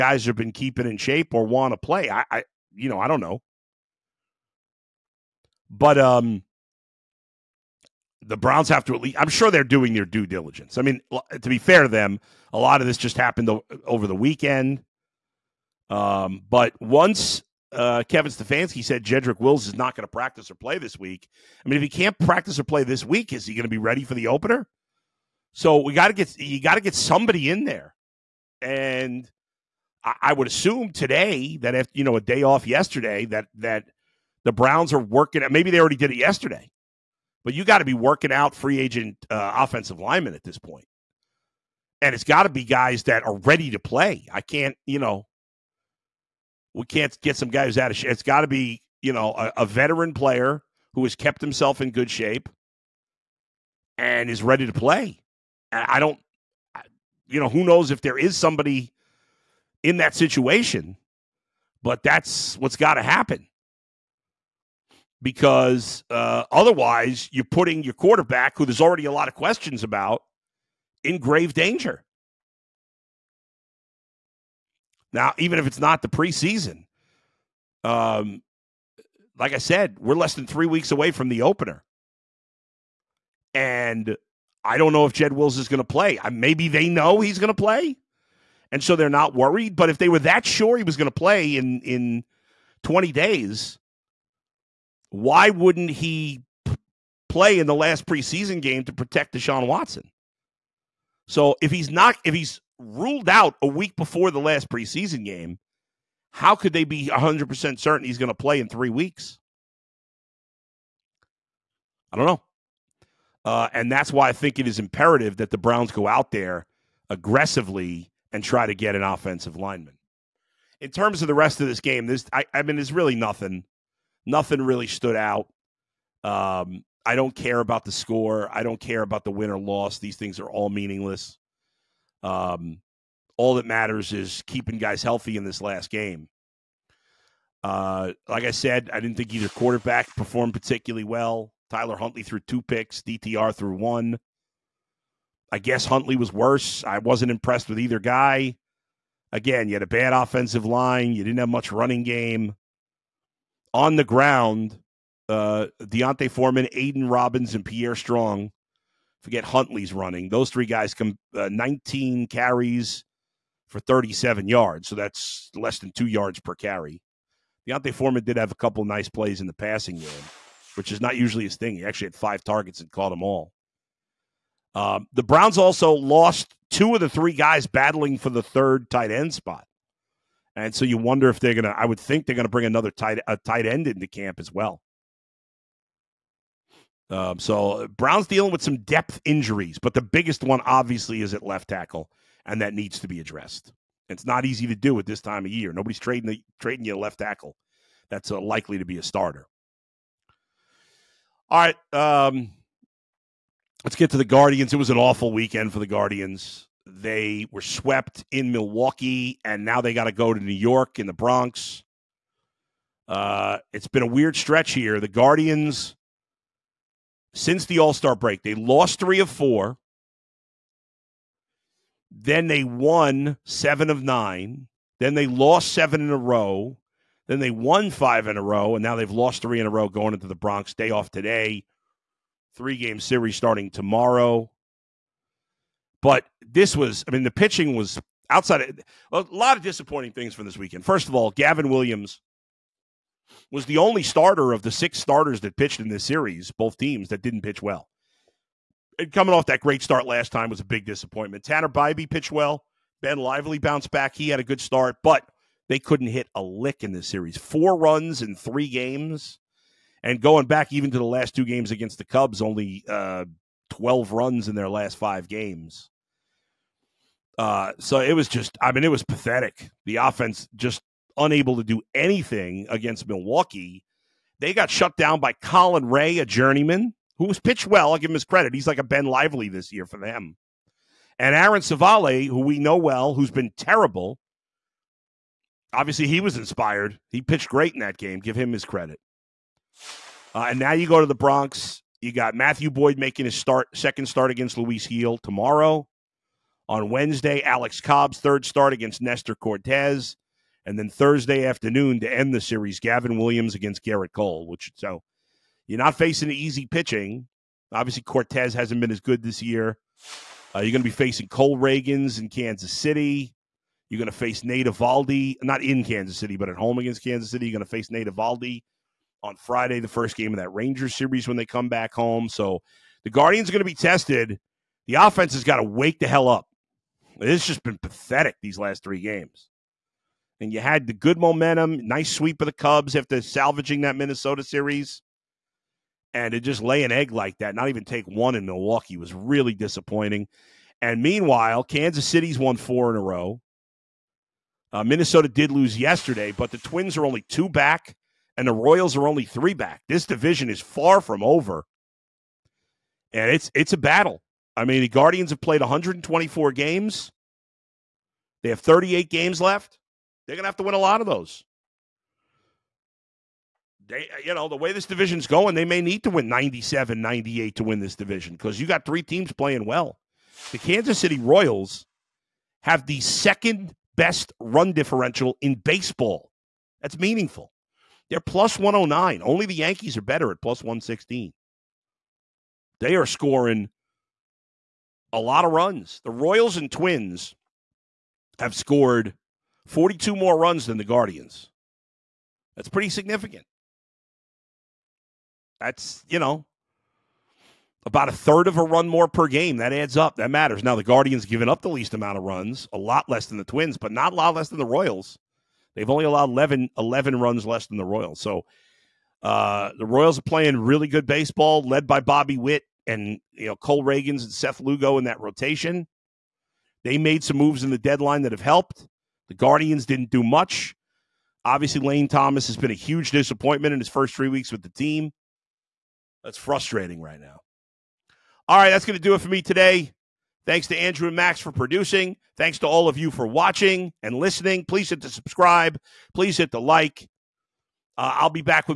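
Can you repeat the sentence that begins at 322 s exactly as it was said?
So the Guardians are going to be tested.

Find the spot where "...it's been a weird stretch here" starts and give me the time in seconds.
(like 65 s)
213 s.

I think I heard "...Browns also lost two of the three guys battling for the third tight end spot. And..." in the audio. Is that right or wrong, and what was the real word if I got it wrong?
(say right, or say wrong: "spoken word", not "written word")
right.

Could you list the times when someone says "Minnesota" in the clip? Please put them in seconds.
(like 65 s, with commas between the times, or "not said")
333 s, 344 s.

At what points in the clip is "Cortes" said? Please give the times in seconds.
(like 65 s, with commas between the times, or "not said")
299 s, 308 s.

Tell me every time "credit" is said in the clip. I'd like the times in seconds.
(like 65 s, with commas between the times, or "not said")
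278 s, 288 s.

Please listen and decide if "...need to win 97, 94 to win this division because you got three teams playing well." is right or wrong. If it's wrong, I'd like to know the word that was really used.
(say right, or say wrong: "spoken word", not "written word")
wrong: "98", not "94".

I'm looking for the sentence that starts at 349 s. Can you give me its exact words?
This division is far from over, and it's it's a battle.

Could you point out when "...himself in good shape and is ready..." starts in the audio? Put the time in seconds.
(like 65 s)
51 s.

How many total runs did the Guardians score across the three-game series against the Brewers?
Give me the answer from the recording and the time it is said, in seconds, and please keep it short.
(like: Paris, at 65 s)
4, at 257 s.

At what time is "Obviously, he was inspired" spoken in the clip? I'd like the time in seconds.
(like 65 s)
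285 s.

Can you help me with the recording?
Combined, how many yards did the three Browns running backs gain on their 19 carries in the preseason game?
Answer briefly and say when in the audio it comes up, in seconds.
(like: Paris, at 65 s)
37, at 163 s.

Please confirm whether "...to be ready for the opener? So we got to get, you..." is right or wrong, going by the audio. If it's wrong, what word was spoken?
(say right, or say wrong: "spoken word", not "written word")
right.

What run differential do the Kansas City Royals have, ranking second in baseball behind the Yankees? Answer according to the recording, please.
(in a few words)
+109.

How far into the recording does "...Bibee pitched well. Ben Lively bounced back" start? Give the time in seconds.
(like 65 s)
251 s.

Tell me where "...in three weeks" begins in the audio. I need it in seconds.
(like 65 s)
108 s.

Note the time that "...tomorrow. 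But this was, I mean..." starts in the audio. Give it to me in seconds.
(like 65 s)
233 s.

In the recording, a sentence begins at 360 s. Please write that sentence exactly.
They're gonna have to win a lot of those.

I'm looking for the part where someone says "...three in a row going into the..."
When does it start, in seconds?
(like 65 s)
229 s.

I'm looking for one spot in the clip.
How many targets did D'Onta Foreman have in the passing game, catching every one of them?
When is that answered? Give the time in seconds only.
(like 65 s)
172 s.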